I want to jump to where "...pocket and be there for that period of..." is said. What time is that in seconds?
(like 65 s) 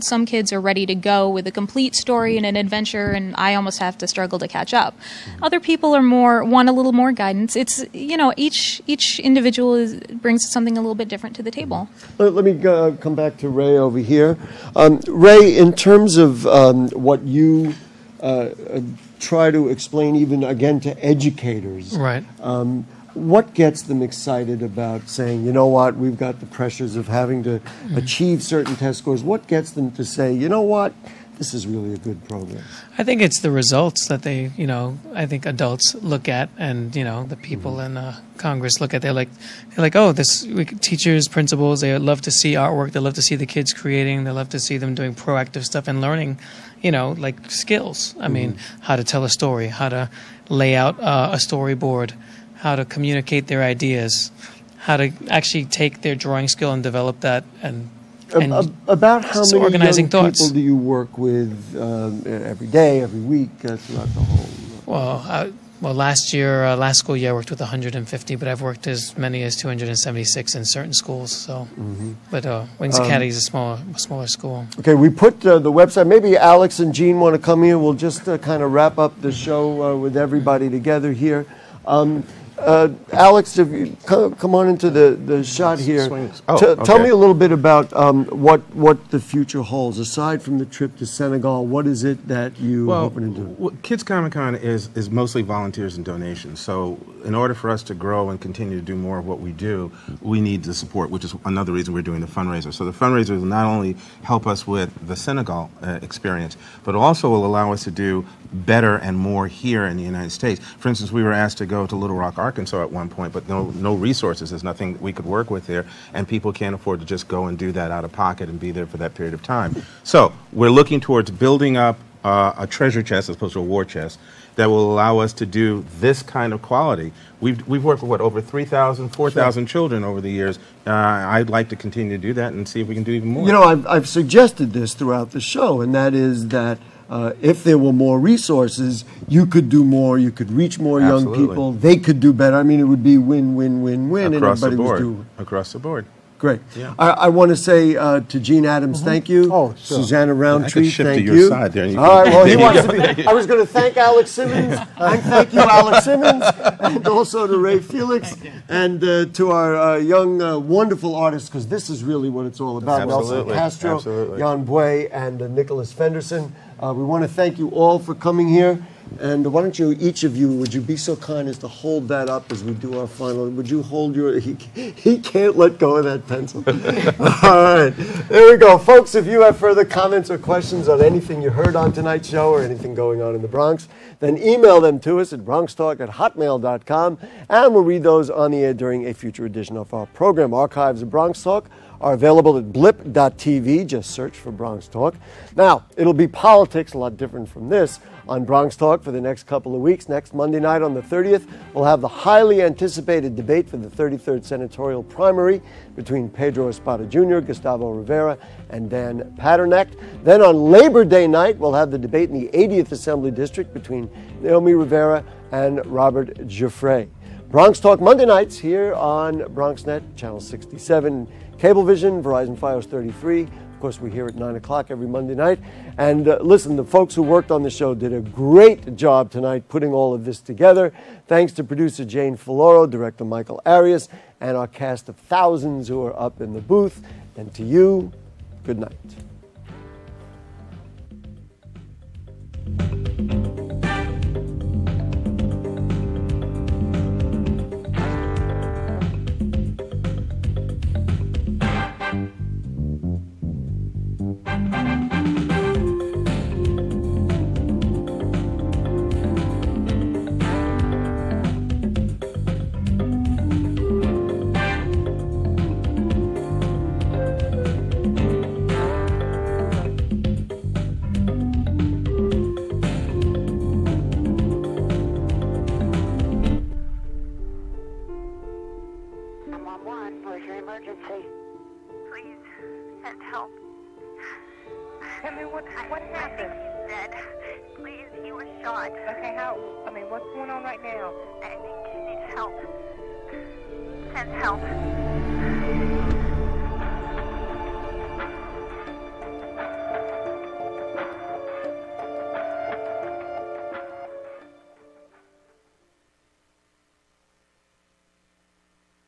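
118 s.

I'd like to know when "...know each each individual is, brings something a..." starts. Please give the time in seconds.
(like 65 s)
8 s.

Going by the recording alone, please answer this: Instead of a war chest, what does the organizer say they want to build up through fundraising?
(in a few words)
A treasure chest.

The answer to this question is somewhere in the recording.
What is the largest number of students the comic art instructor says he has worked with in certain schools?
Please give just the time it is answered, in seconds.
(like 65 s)
69 s.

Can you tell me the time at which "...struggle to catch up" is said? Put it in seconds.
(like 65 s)
4 s.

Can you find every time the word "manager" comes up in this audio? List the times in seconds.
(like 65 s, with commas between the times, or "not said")
not said.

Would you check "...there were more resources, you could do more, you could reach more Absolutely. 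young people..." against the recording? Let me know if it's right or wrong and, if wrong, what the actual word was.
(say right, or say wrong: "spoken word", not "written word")
right.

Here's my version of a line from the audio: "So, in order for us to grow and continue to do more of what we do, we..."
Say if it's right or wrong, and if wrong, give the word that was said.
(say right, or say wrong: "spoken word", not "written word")
right.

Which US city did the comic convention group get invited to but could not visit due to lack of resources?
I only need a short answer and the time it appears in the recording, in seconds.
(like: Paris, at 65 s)
Little Rock, Arkansas, at 111 s.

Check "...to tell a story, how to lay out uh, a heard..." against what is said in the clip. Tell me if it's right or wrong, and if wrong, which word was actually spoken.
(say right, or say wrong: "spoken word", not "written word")
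wrong: "storyboard", not "heard".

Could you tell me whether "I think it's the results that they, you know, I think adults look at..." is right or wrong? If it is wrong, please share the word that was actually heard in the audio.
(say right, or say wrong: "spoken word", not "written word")
right.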